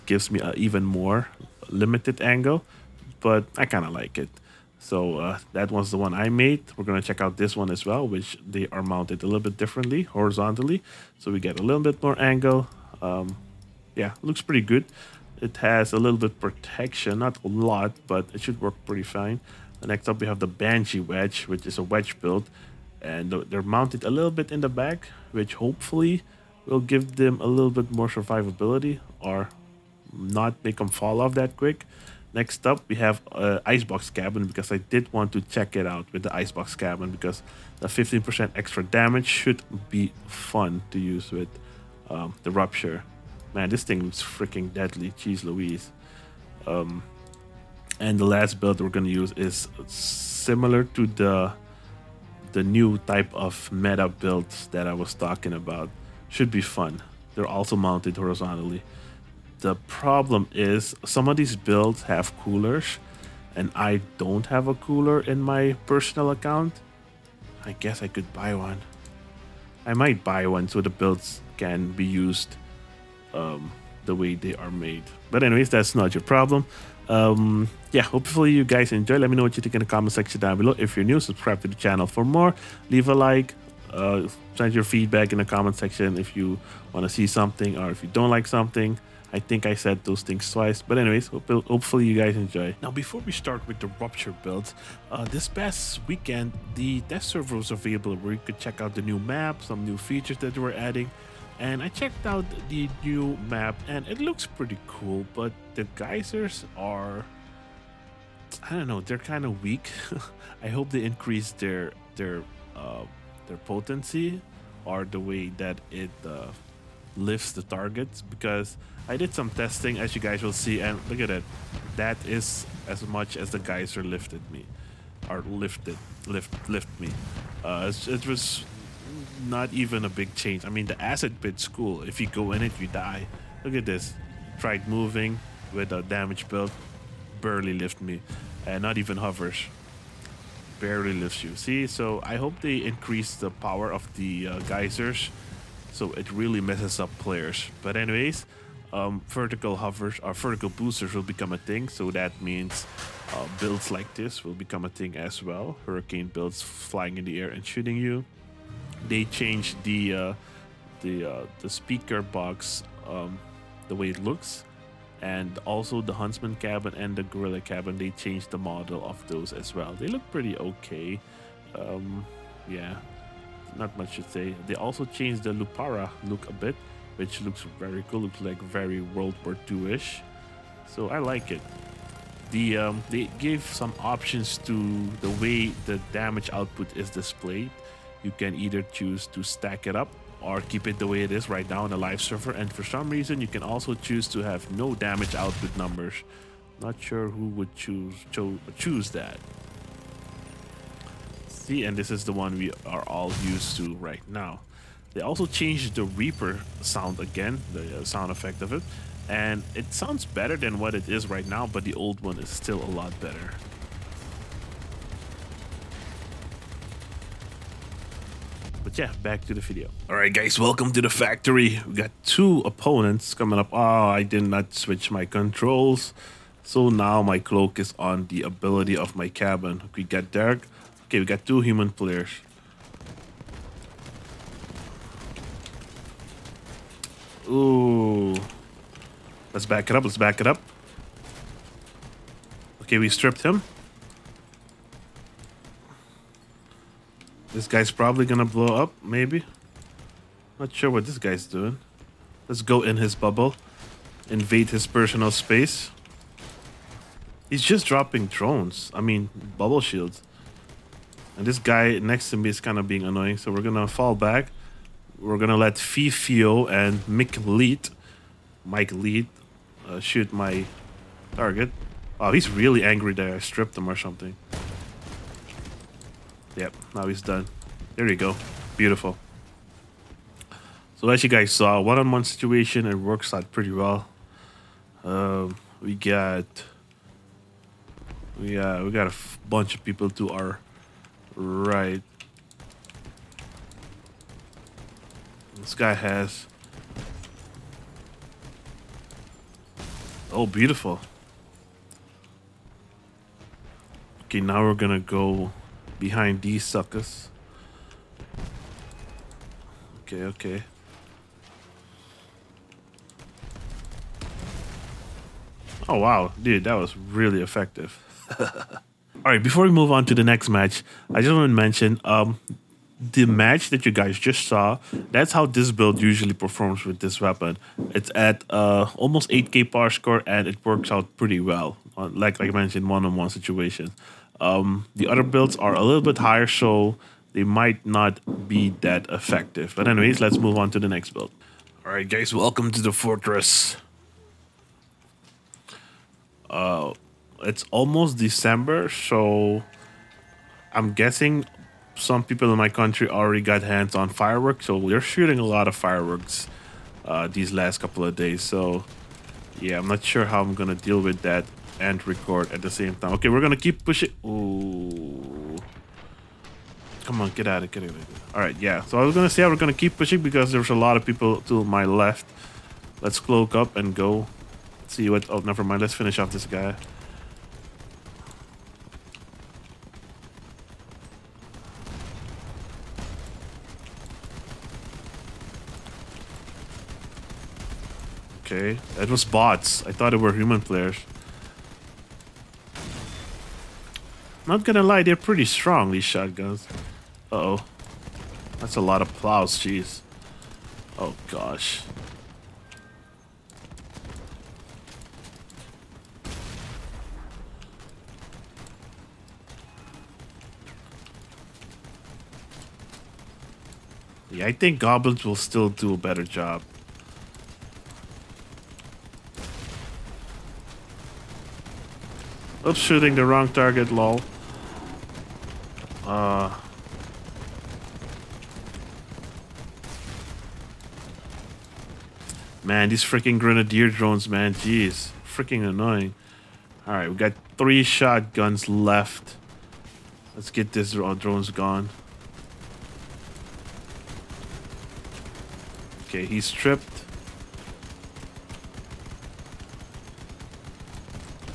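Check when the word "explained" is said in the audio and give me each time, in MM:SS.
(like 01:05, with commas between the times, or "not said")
not said.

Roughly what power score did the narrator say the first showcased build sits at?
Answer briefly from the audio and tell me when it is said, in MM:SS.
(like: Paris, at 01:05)
almost 8k, at 05:28.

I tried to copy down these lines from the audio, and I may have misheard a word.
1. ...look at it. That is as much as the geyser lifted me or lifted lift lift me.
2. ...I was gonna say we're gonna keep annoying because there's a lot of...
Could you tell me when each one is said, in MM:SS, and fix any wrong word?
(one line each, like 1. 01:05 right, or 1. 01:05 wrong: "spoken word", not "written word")
1. 02:01 right
2. 06:08 wrong: "pushing", not "annoying".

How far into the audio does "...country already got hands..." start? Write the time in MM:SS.
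05:52.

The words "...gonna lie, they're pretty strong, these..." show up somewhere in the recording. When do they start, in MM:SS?
06:34.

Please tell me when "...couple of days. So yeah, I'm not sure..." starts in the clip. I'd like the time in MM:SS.
05:57.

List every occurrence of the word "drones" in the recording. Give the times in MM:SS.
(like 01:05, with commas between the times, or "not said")
04:18, 07:13, 07:20.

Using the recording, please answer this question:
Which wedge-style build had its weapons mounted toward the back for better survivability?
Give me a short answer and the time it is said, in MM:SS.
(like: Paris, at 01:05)
Banshee Wedge, at 00:20.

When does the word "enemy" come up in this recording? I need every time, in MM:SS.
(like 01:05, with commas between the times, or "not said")
not said.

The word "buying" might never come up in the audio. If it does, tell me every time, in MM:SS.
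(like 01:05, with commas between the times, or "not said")
not said.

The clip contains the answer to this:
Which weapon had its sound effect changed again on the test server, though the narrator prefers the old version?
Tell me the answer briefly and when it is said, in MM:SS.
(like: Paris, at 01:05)
Reaper, at 03:26.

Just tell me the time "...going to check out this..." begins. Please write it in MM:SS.
00:06.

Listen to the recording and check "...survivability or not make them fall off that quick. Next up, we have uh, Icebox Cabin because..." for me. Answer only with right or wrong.
right.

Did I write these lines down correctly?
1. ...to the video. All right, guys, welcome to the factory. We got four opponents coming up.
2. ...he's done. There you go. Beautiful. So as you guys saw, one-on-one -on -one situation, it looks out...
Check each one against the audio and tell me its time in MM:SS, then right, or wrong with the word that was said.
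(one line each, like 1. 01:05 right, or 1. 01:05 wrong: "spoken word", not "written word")
1. 03:39 wrong: "two", not "four"
2. 04:37 wrong: "works", not "looks".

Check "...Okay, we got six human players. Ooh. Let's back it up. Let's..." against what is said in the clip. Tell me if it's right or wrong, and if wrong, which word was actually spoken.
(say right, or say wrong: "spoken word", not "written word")
wrong: "two", not "six".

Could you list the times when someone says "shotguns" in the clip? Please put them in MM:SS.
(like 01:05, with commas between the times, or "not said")
06:36, 07:17.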